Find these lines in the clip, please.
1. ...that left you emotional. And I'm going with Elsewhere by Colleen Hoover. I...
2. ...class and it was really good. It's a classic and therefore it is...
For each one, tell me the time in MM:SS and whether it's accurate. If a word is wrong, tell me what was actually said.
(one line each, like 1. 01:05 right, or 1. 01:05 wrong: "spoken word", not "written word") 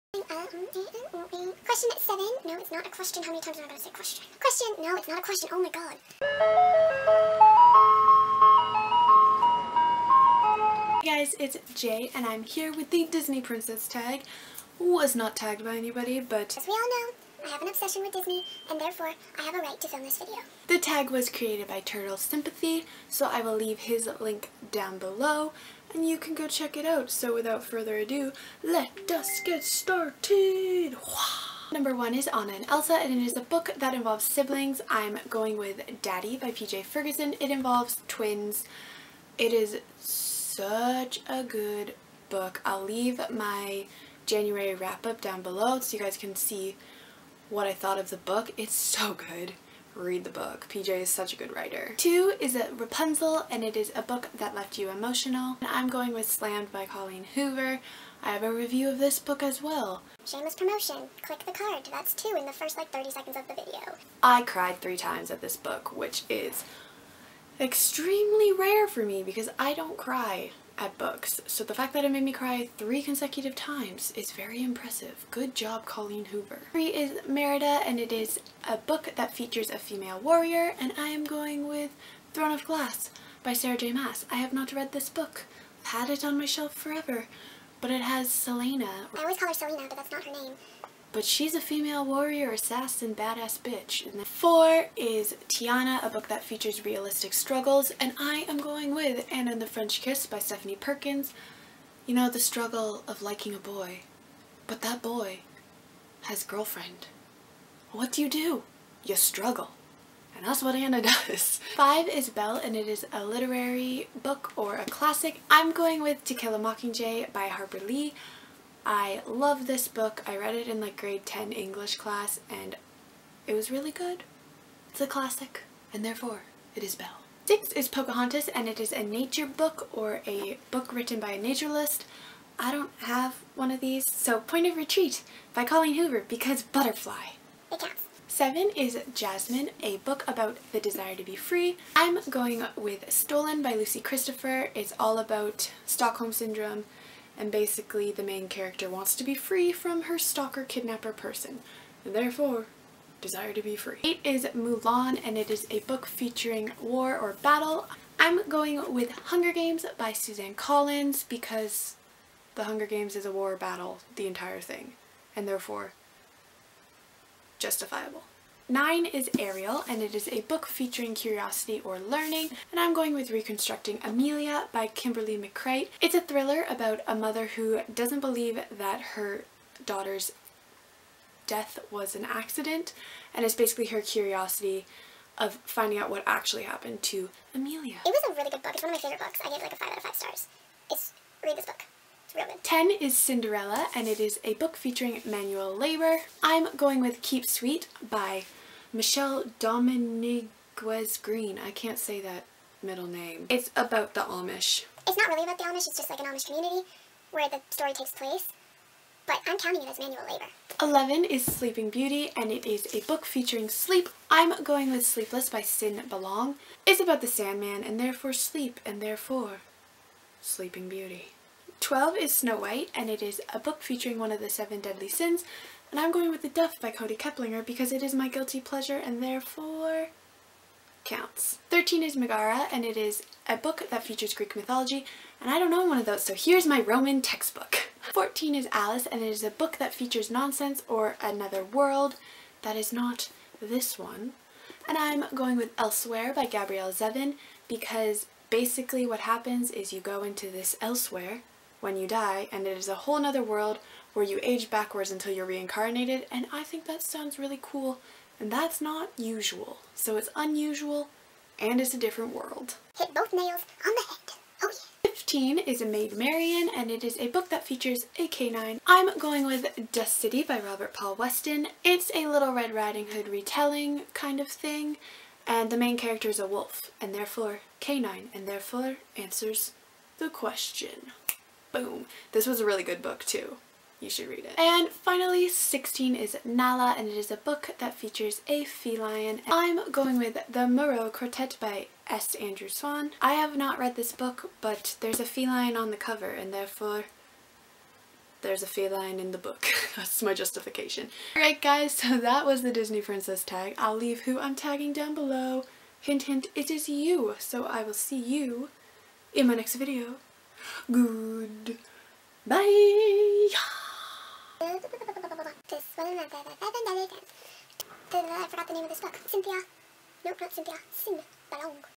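1. 00:54 wrong: "Slammed", not "Elsewhere"
2. 02:01 right.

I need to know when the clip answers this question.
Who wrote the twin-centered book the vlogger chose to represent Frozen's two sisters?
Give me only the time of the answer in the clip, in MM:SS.
00:36.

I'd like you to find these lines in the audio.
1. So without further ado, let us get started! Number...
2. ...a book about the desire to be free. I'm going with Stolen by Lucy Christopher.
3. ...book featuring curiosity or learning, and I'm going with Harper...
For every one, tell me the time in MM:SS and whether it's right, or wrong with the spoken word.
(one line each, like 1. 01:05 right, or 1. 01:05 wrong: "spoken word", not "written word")
1. 00:27 right
2. 02:19 right
3. 02:50 wrong: "Reconstructing", not "Harper".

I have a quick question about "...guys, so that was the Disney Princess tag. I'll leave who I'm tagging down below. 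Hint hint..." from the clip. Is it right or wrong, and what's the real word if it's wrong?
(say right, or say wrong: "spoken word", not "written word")
right.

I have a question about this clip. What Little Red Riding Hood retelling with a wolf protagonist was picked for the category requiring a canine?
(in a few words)
Dust City.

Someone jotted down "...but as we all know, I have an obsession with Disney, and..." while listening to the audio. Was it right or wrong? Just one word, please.
right.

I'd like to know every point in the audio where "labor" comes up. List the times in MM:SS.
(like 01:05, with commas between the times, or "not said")
03:15, 03:30.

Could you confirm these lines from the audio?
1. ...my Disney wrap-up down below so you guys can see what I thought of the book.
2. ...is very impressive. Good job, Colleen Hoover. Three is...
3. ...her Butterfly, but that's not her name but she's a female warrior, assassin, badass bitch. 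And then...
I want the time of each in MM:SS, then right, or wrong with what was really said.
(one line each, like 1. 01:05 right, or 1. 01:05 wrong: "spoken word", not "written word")
1. 00:43 wrong: "January", not "Disney"
2. 01:14 right
3. 01:29 wrong: "Selena", not "Butterfly".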